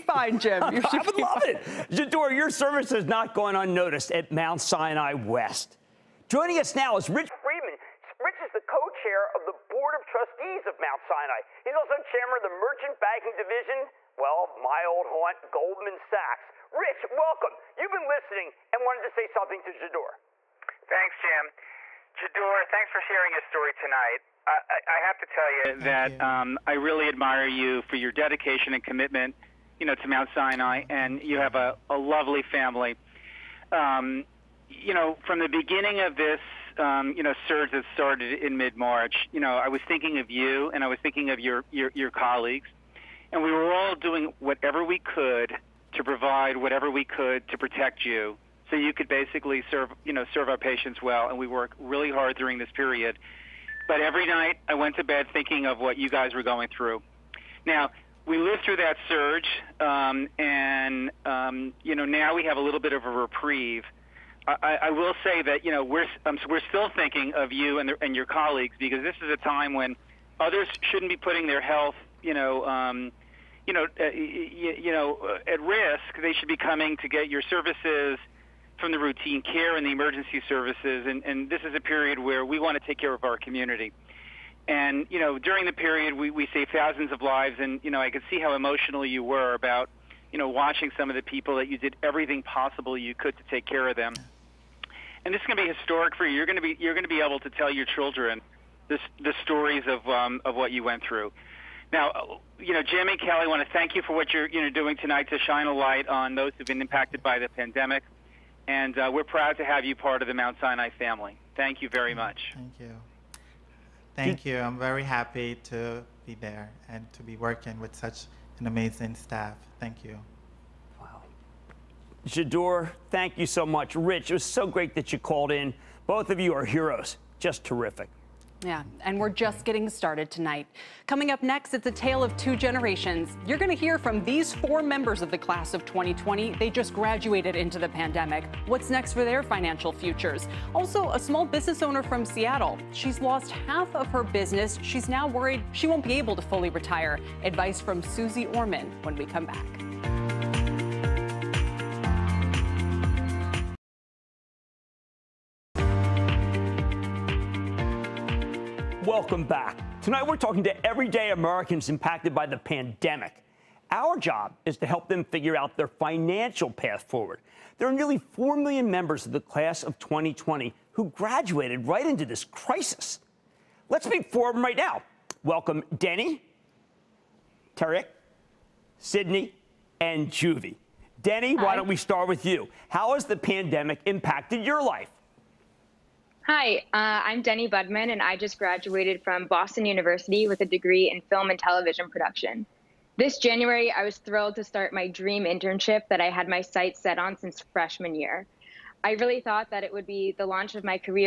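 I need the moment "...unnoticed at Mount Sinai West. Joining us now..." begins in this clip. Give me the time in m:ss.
0:03.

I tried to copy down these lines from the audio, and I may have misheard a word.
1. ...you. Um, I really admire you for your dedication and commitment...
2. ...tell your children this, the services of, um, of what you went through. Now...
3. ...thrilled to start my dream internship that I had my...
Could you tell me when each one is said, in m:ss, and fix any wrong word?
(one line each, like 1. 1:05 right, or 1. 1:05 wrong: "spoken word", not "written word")
1. 0:26 right
2. 1:37 wrong: "stories", not "services"
3. 3:14 right.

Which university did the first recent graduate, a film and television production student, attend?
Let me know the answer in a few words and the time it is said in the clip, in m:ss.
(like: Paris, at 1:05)
Boston University, at 3:09.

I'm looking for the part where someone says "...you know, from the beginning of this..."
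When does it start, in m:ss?
0:34.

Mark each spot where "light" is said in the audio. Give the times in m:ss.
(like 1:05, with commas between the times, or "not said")
1:45.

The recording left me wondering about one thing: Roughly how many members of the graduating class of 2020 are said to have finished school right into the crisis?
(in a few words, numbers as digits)
nearly 4 million.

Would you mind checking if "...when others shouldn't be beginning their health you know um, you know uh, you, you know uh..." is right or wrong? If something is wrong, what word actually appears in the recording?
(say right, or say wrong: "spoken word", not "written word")
wrong: "putting", not "beginning".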